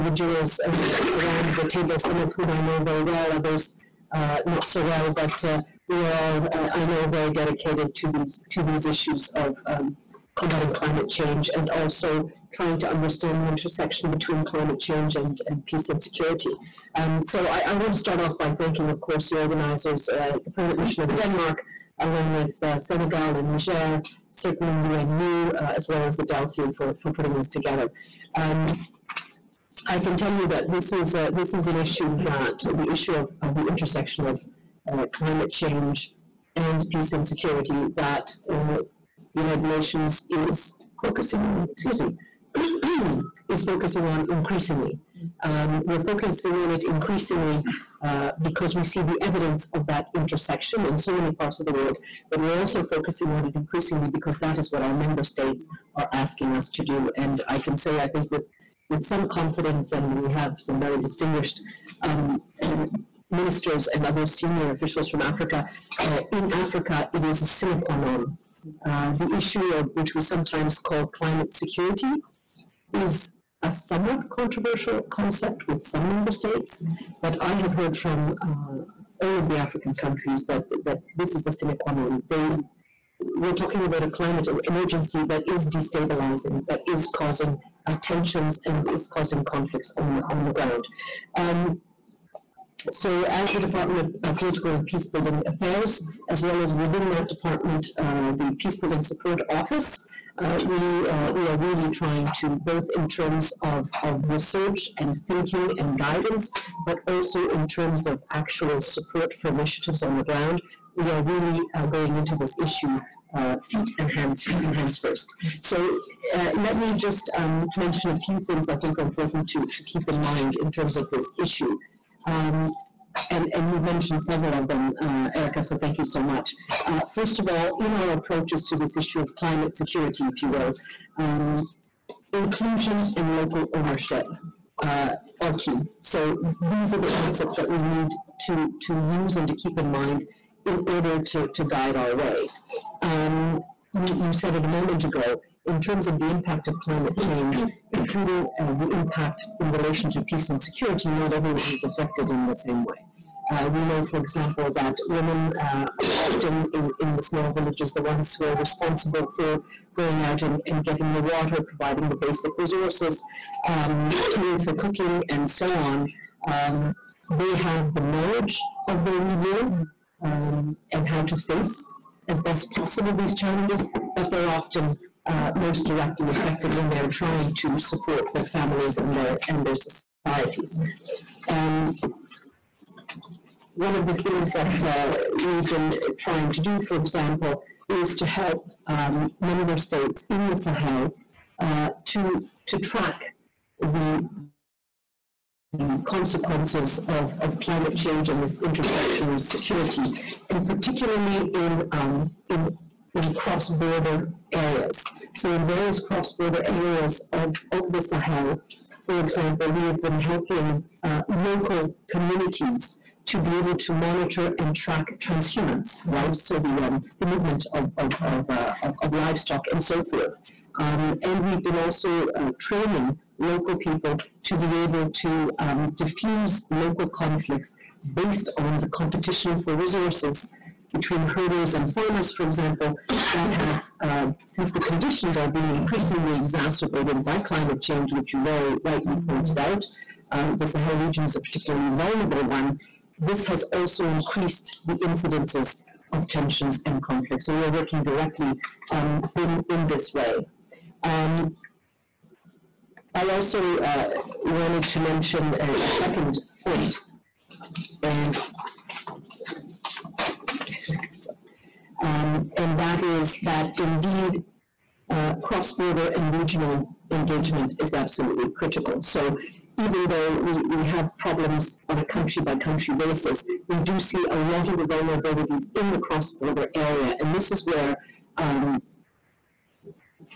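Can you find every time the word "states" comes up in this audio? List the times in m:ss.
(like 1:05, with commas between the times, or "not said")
0:55, 1:16, 3:09.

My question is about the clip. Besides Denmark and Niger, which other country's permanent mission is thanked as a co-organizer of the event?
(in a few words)
Senegal.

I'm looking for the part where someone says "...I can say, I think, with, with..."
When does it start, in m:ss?
0:57.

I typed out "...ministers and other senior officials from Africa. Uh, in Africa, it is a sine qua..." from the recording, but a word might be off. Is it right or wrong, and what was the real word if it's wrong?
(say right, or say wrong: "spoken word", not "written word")
right.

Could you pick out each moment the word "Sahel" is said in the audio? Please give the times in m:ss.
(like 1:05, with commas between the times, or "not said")
3:10, 3:28, 4:00.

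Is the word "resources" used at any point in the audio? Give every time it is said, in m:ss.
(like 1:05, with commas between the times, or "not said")
2:42, 3:49.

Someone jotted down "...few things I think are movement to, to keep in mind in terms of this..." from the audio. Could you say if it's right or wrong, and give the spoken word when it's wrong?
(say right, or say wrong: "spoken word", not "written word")
wrong: "important", not "movement".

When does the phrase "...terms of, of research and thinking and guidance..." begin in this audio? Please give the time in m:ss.
1:43.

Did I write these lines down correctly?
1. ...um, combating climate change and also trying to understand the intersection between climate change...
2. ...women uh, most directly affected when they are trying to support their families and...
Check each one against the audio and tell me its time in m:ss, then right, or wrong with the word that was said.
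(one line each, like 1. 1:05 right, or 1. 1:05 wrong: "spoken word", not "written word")
1. 0:09 right
2. 2:54 wrong: "often", not "women".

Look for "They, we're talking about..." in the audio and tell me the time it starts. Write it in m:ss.
1:22.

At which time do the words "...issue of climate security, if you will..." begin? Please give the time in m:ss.
2:08.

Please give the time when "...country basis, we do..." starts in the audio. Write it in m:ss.
4:32.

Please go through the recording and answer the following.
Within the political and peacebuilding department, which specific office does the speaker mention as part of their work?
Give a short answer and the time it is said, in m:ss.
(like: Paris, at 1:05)
Peacebuilding Support Office, at 1:38.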